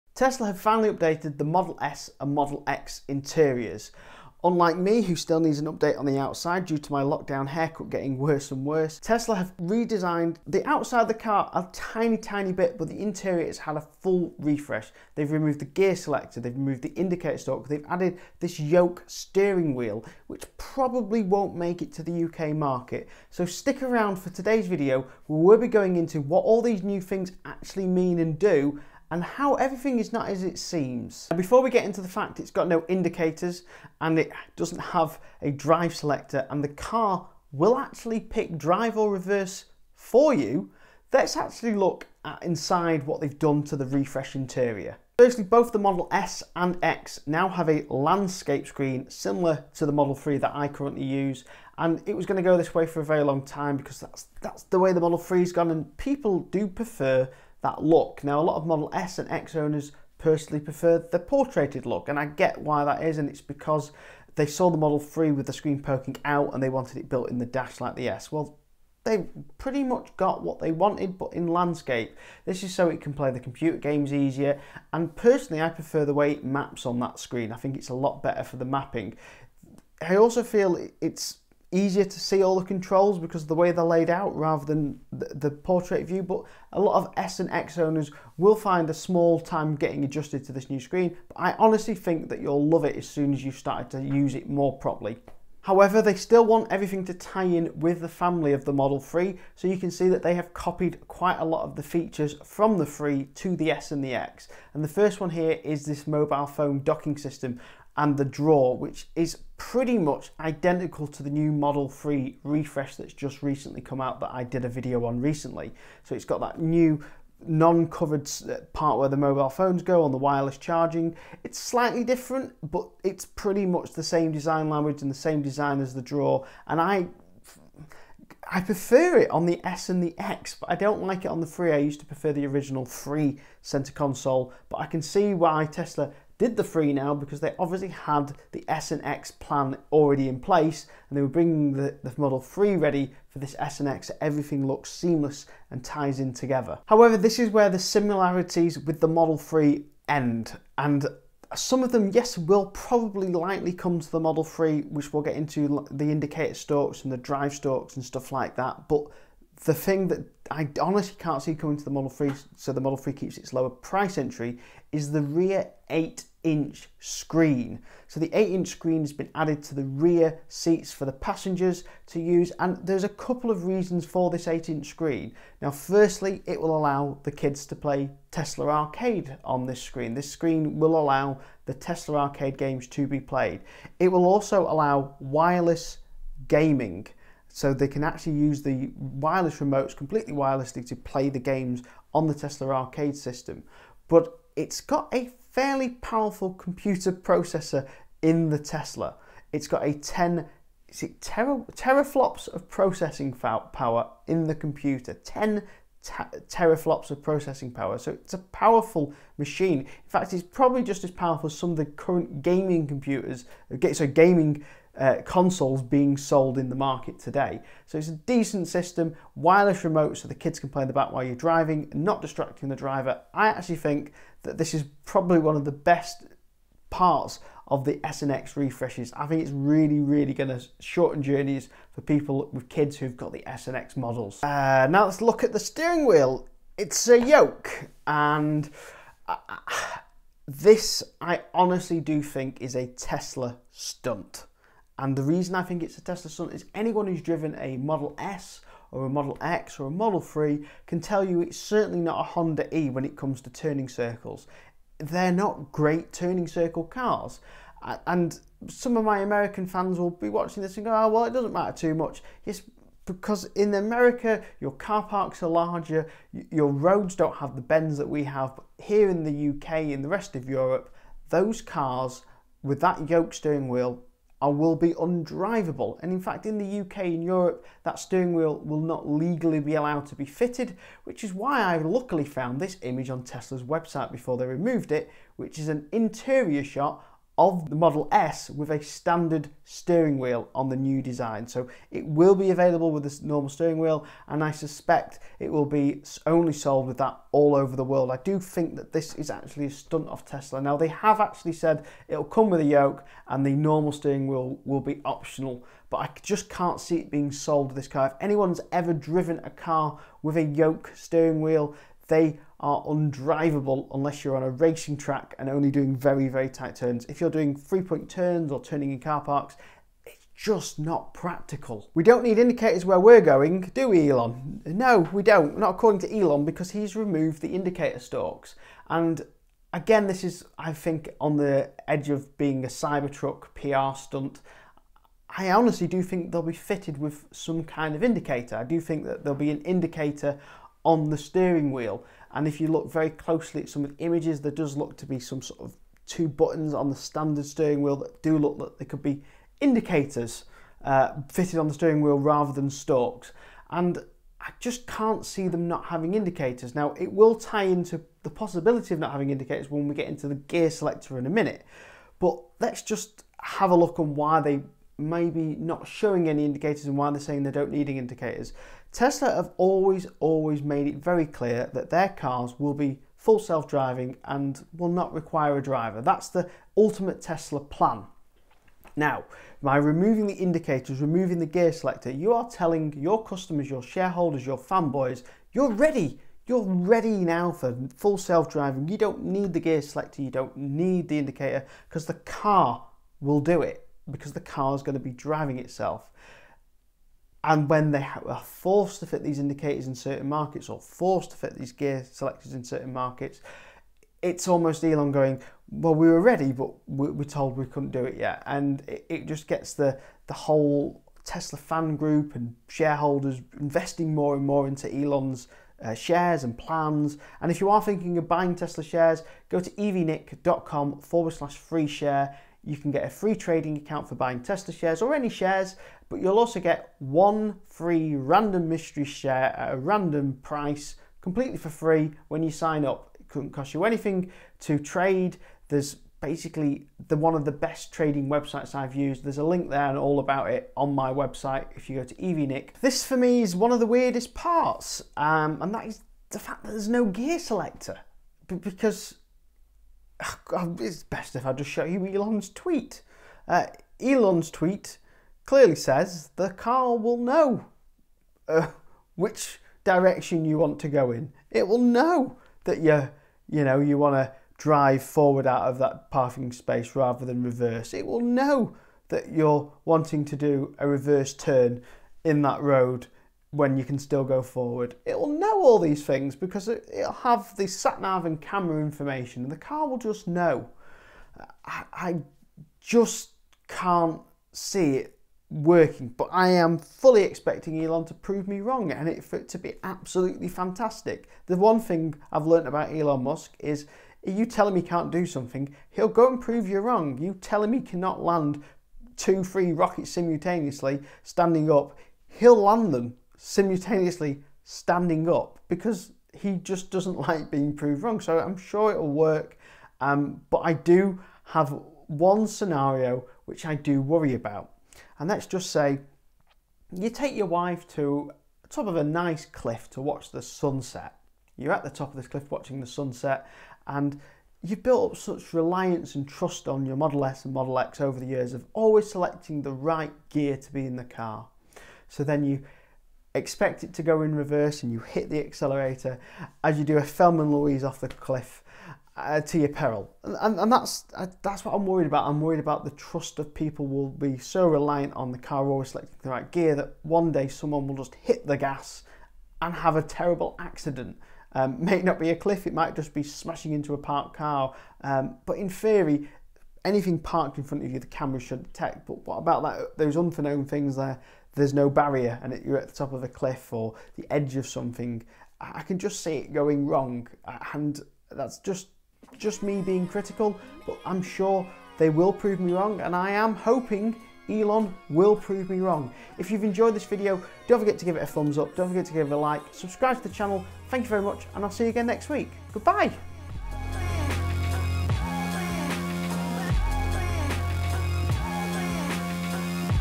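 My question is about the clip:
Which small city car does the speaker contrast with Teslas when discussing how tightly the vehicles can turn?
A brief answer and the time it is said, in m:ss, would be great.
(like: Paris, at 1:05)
Honda E, at 4:12.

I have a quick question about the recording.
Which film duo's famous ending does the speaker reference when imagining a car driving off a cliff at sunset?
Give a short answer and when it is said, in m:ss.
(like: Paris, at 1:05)
Thelma and Louise, at 8:57.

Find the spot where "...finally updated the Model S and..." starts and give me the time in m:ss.
0:00.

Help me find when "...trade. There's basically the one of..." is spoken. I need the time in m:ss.
7:14.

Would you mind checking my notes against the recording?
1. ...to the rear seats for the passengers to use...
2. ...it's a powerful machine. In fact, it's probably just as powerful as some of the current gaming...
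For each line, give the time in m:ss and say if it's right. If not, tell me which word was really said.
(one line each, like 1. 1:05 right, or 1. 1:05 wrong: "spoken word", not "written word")
1. 2:49 right
2. 3:28 right.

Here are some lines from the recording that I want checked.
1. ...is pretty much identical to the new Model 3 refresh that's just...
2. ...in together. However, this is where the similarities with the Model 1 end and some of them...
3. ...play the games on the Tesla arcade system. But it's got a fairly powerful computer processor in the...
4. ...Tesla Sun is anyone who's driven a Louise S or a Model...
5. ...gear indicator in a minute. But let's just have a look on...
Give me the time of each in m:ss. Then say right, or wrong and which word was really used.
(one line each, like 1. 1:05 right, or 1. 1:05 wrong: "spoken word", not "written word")
1. 1:49 right
2. 2:26 wrong: "3", not "1"
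3. 3:10 right
4. 4:06 wrong: "Model", not "Louise"
5. 6:00 wrong: "selector", not "indicator".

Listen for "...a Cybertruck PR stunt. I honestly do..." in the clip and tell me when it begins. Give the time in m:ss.
5:32.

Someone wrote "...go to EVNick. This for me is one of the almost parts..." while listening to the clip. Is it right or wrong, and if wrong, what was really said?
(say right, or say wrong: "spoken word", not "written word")
wrong: "weirdest", not "almost".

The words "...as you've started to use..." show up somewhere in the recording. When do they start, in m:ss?
1:33.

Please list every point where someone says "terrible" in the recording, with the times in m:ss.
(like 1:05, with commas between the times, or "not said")
9:10.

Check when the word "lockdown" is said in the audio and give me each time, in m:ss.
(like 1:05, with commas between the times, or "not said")
0:07.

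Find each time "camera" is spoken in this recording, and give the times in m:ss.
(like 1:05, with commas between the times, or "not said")
7:58, 9:18.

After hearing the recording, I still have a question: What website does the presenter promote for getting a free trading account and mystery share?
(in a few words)
evnick.com.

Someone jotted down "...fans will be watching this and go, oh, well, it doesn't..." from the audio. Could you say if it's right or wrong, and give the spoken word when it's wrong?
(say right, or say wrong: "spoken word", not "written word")
right.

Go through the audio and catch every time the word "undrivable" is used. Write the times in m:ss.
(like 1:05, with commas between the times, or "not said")
4:34, 5:12.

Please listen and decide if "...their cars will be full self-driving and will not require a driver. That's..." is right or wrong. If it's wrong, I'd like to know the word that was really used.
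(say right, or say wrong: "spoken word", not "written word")
right.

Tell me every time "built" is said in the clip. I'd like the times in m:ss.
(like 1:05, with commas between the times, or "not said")
1:07, 8:44.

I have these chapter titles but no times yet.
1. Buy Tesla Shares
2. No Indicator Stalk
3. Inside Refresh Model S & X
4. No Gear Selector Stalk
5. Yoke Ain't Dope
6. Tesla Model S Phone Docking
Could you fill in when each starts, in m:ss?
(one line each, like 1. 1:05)
1. 6:56
2. 5:21
3. 0:31
4. 7:22
5. 3:54
6. 1:36.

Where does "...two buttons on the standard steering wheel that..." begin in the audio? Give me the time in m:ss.
5:46.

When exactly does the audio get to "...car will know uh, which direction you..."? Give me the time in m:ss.
7:36.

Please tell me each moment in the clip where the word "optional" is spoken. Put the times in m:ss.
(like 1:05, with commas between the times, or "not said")
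5:05.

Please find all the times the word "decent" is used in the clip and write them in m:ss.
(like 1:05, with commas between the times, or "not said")
3:38.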